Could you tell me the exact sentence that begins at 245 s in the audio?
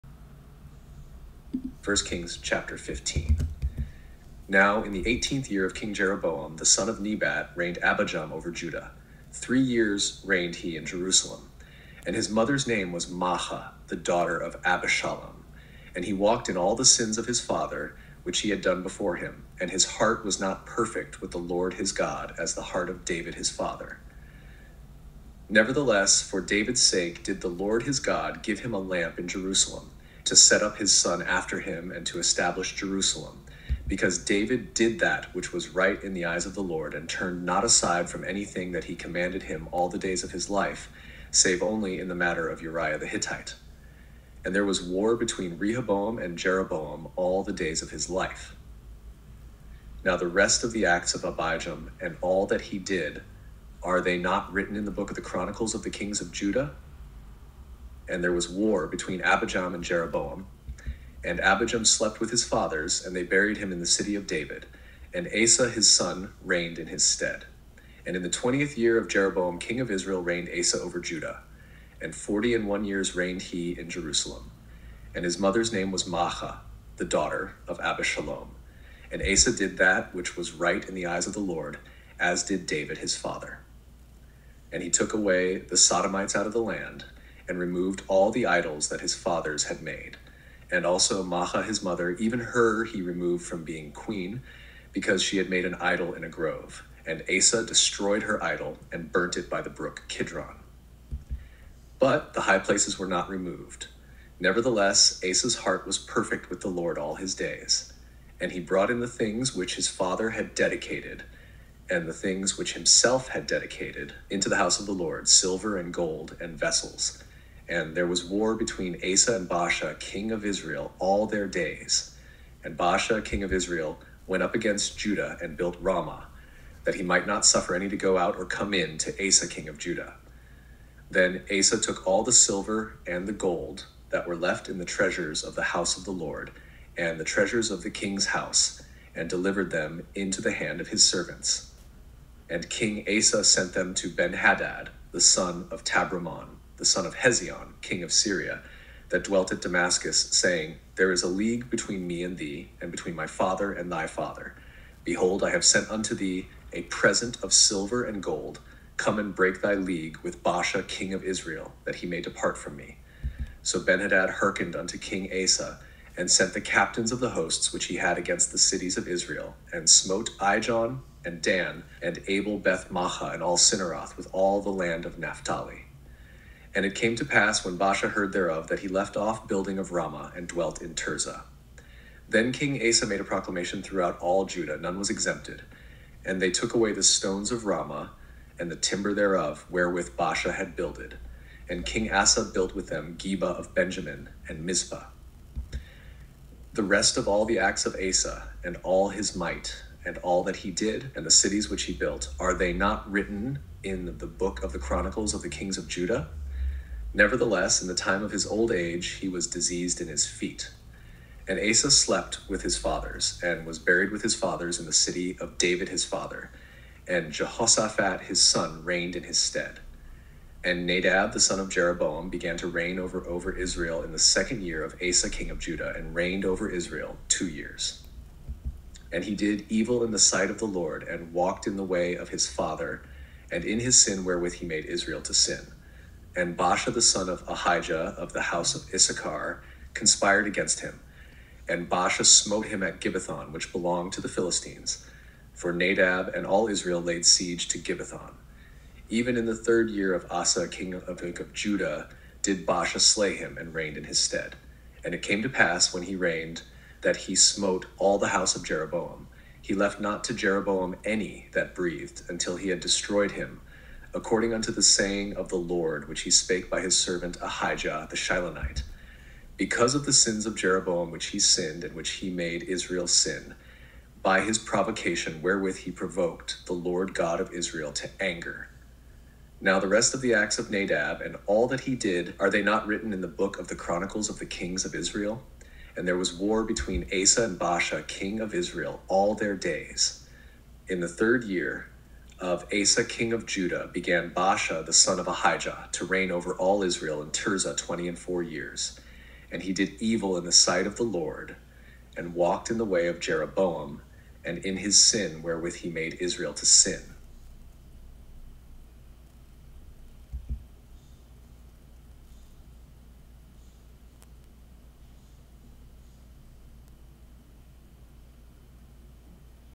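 For Nadab and all Israel laid siege to Gibbethon.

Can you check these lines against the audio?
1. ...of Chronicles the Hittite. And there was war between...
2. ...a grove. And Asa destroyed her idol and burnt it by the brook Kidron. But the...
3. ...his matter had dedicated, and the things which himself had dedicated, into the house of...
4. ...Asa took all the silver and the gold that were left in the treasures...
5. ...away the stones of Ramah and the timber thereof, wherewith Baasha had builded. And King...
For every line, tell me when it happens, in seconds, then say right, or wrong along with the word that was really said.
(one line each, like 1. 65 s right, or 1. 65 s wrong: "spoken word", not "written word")
1. 42 s wrong: "Uriah", not "Chronicles"
2. 96 s right
3. 109 s wrong: "father", not "matter"
4. 131 s right
5. 186 s right.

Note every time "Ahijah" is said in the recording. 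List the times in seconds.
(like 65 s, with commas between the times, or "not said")
237 s, 267 s, 295 s.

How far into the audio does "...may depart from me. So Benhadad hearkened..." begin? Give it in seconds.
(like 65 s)
162 s.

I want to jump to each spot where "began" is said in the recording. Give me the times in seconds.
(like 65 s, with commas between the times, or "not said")
222 s, 293 s.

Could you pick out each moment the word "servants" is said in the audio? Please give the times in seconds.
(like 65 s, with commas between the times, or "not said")
141 s, 266 s.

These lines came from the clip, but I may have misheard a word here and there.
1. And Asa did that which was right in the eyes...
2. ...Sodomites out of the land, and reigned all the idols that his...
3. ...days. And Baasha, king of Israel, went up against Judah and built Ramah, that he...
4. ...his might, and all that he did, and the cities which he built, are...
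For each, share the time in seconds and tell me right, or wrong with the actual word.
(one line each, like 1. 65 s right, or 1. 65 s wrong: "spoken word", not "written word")
1. 79 s right
2. 85 s wrong: "removed", not "reigned"
3. 121 s right
4. 199 s right.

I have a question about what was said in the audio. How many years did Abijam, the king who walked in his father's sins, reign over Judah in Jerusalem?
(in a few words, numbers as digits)
3.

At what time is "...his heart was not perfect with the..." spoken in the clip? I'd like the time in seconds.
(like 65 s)
19 s.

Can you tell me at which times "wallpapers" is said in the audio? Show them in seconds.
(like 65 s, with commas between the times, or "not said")
not said.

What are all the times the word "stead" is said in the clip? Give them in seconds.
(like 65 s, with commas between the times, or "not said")
67 s, 219 s, 254 s.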